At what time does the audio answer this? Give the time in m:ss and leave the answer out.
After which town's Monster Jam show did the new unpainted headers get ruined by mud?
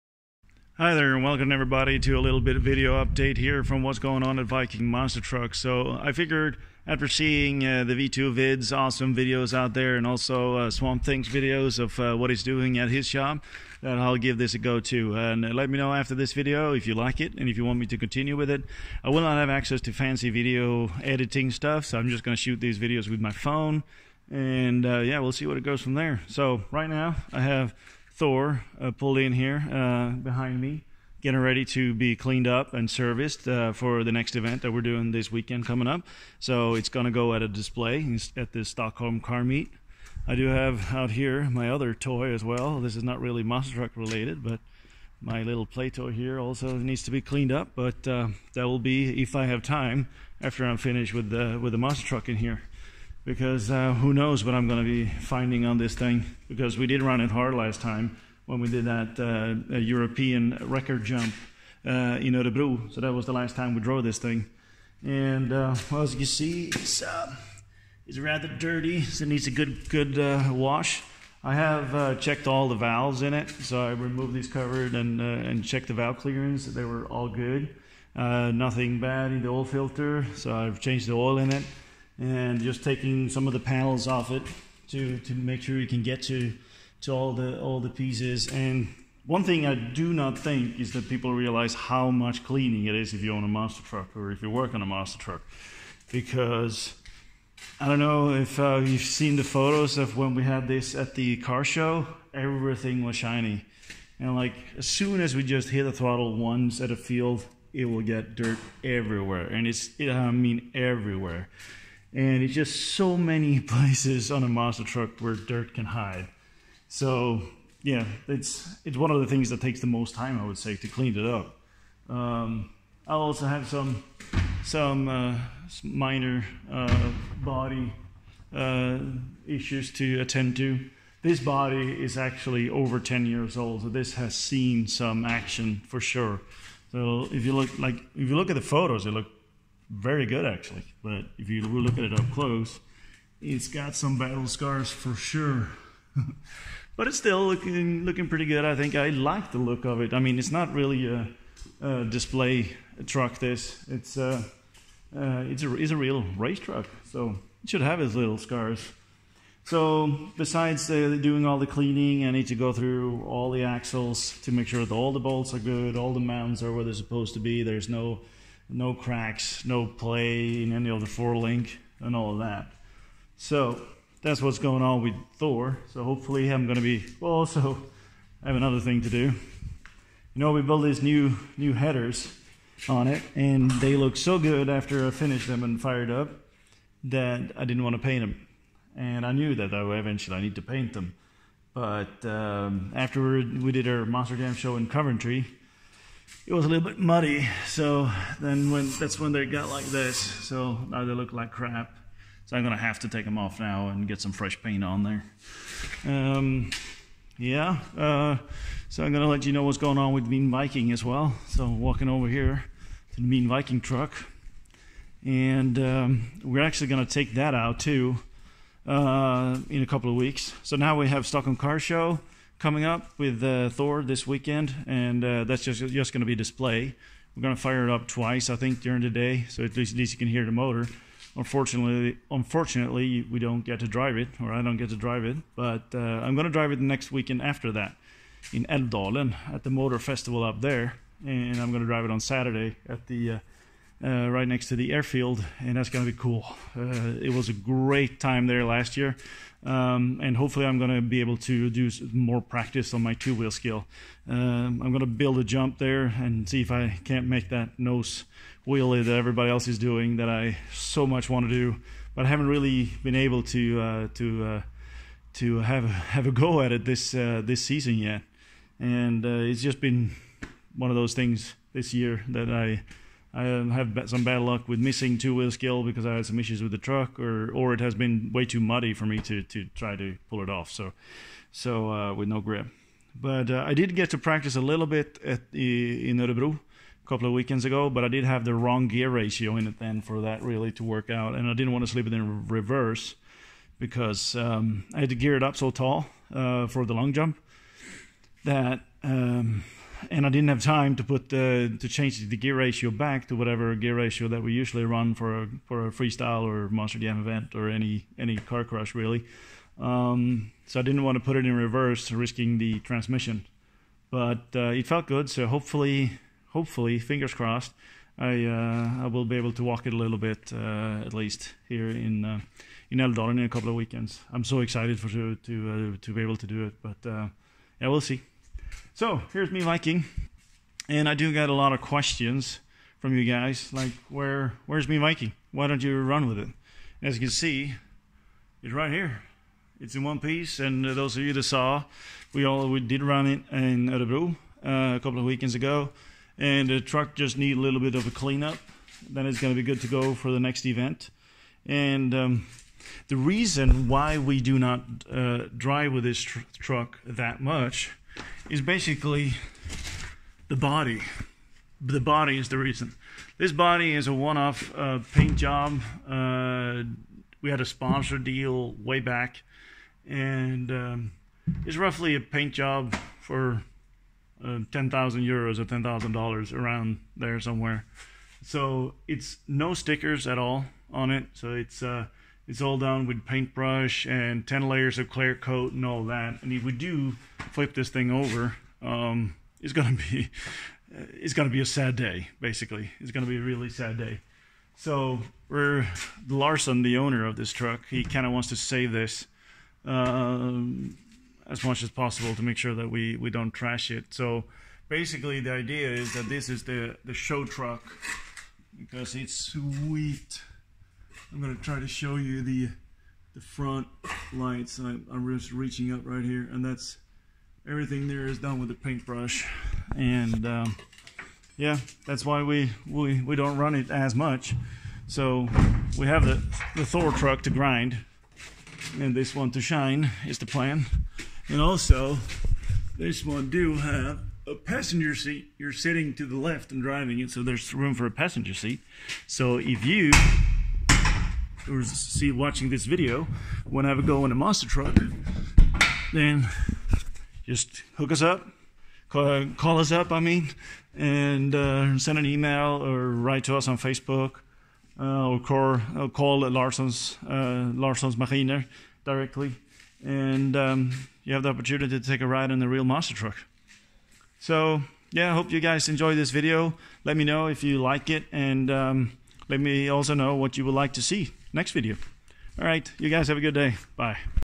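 3:14.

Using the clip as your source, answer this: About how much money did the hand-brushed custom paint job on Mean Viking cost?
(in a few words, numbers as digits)
10,000 euros.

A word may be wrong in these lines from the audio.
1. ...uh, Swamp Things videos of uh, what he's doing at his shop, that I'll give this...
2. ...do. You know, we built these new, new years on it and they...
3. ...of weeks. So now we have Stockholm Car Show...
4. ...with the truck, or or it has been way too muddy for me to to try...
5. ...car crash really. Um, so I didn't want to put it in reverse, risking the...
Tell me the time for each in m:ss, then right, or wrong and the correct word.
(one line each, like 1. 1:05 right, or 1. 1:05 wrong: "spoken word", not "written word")
1. 0:10 right
2. 2:59 wrong: "headers", not "years"
3. 3:40 right
4. 4:36 right
5. 5:08 right.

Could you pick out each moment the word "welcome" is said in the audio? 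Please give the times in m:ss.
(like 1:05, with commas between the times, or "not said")
0:01.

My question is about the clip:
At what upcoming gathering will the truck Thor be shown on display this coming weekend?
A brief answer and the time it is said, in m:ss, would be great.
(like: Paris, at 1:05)
Stockholm Car Meet, at 0:38.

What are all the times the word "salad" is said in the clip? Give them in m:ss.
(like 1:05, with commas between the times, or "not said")
not said.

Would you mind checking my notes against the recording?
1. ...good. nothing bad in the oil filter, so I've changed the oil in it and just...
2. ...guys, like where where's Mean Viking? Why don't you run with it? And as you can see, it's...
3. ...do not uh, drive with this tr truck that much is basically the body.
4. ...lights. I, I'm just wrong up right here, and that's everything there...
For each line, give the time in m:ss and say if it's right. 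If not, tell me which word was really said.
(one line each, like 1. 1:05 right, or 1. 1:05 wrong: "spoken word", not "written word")
1. 1:17 right
2. 5:33 right
3. 5:54 right
4. 6:54 wrong: "reaching", not "wrong".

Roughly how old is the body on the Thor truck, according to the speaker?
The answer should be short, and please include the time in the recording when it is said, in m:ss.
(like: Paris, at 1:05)
over 10 years, at 2:12.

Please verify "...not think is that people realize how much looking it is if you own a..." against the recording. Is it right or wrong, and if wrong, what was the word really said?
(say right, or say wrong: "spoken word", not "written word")
wrong: "cleaning", not "looking".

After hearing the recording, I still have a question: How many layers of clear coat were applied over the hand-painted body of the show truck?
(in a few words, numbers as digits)
10.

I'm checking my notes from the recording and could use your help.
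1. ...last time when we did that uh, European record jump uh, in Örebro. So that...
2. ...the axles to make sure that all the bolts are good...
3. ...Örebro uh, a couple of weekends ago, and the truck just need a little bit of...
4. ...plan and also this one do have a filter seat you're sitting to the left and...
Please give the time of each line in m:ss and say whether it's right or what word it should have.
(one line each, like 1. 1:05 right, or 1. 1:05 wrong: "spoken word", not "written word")
1. 0:57 right
2. 2:43 right
3. 5:43 right
4. 7:10 wrong: "passenger", not "filter".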